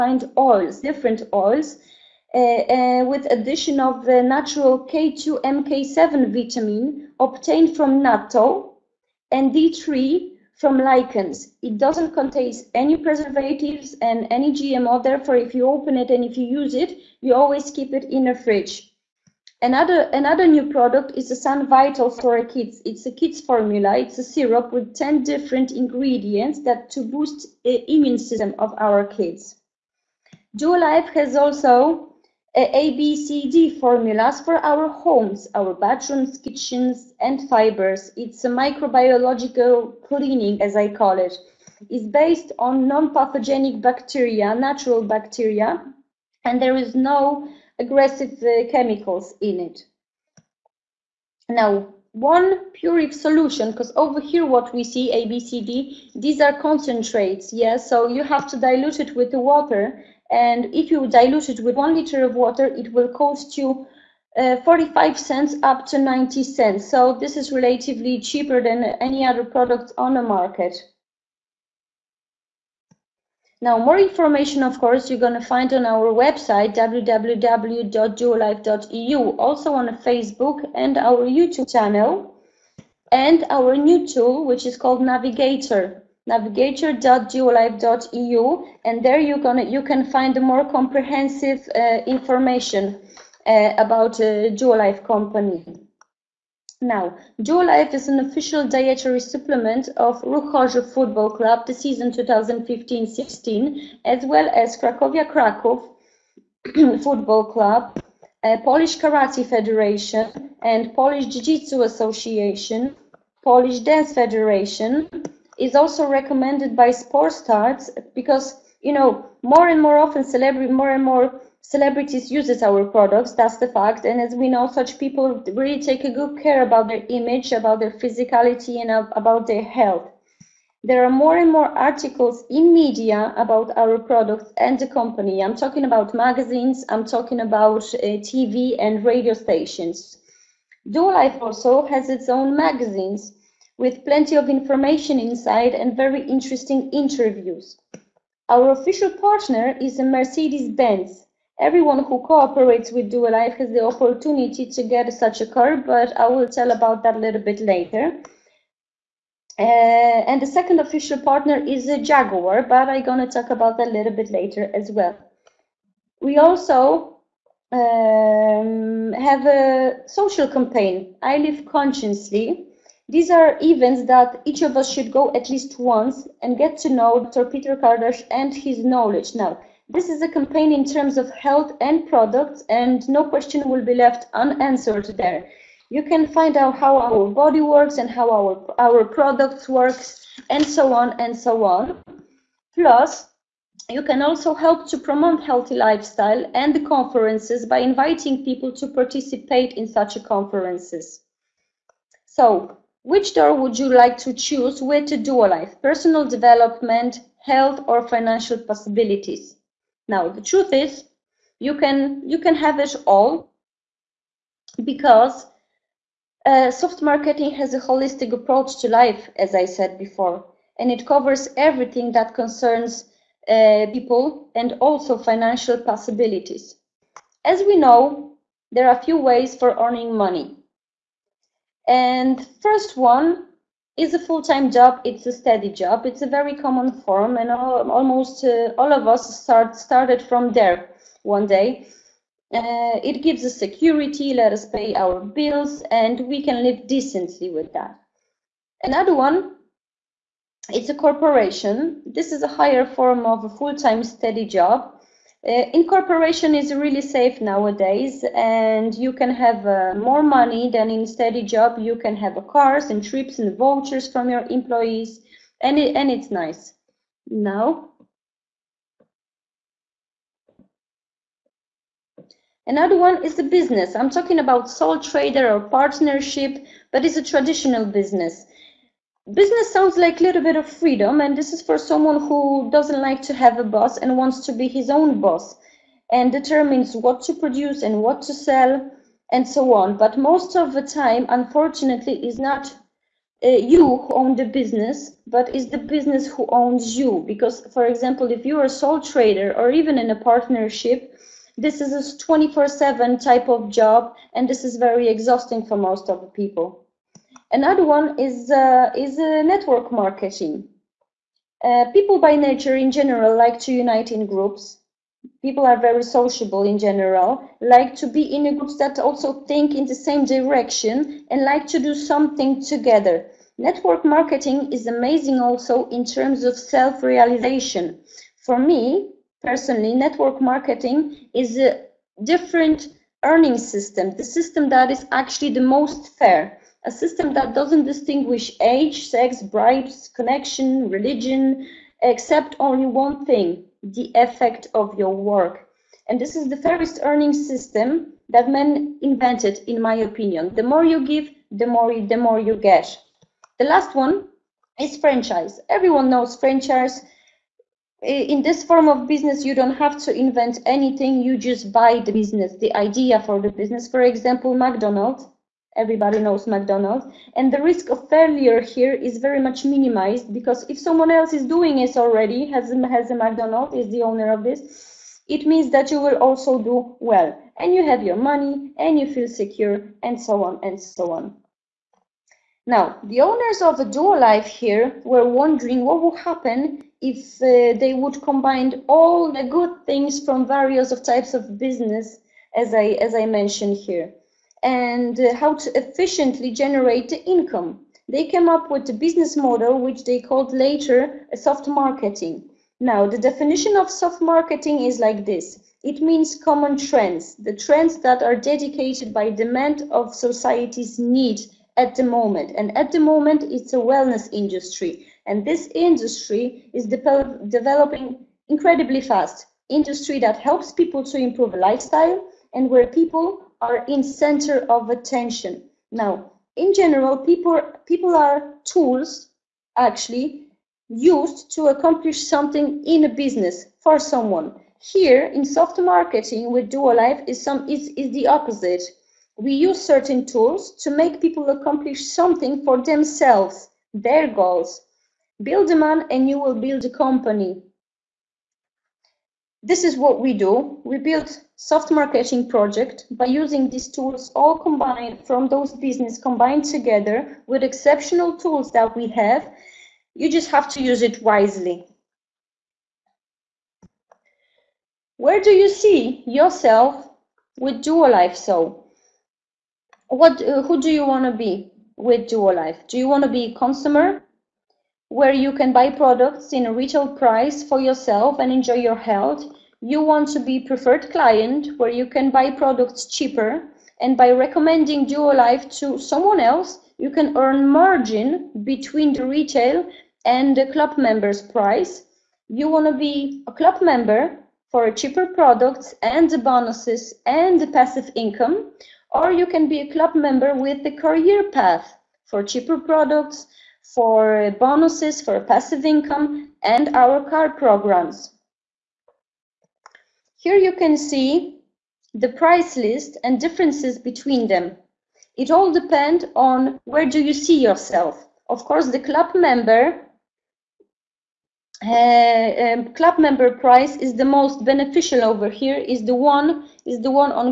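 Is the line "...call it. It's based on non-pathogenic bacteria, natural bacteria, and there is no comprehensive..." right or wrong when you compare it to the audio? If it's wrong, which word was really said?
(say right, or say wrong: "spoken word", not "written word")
wrong: "aggressive", not "comprehensive".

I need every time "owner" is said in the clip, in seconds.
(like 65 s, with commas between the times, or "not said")
374 s, 383 s.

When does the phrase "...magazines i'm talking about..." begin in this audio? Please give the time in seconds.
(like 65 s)
136 s.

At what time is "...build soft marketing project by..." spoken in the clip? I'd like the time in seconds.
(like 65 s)
450 s.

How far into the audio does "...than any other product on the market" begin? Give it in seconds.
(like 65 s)
68 s.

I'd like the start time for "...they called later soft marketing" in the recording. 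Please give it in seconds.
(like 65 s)
400 s.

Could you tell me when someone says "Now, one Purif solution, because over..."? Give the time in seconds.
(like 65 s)
51 s.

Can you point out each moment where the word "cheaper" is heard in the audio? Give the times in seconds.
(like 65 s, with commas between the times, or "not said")
68 s, 483 s, 494 s, 502 s.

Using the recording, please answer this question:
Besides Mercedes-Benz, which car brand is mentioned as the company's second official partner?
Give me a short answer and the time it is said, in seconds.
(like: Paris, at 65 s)
Jaguar, at 162 s.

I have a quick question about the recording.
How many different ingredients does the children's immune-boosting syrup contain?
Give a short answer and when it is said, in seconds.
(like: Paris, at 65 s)
10, at 24 s.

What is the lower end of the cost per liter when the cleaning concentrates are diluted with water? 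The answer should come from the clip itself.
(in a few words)
45 cents.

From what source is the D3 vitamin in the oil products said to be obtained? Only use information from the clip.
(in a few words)
Lichens.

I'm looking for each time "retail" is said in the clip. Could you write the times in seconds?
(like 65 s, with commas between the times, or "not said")
476 s, 489 s.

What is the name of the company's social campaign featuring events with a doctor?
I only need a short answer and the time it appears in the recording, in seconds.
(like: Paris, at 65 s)
I Live Consciously, at 171 s.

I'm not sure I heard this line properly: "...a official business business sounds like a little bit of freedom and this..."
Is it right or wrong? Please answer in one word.
wrong.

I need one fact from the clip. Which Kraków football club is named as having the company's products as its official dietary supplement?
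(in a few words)
Krakowia Kraków.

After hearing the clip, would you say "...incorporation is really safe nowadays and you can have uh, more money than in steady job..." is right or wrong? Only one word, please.
right.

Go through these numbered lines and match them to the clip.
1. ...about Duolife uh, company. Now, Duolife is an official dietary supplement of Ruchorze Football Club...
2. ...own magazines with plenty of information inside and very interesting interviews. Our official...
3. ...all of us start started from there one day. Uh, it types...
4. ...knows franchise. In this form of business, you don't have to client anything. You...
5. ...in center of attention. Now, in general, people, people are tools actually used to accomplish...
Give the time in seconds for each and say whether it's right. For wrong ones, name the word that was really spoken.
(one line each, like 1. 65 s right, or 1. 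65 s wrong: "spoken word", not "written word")
1. 93 s right
2. 142 s right
3. 238 s wrong: "gives", not "types"
4. 356 s wrong: "invent", not "client"
5. 423 s right.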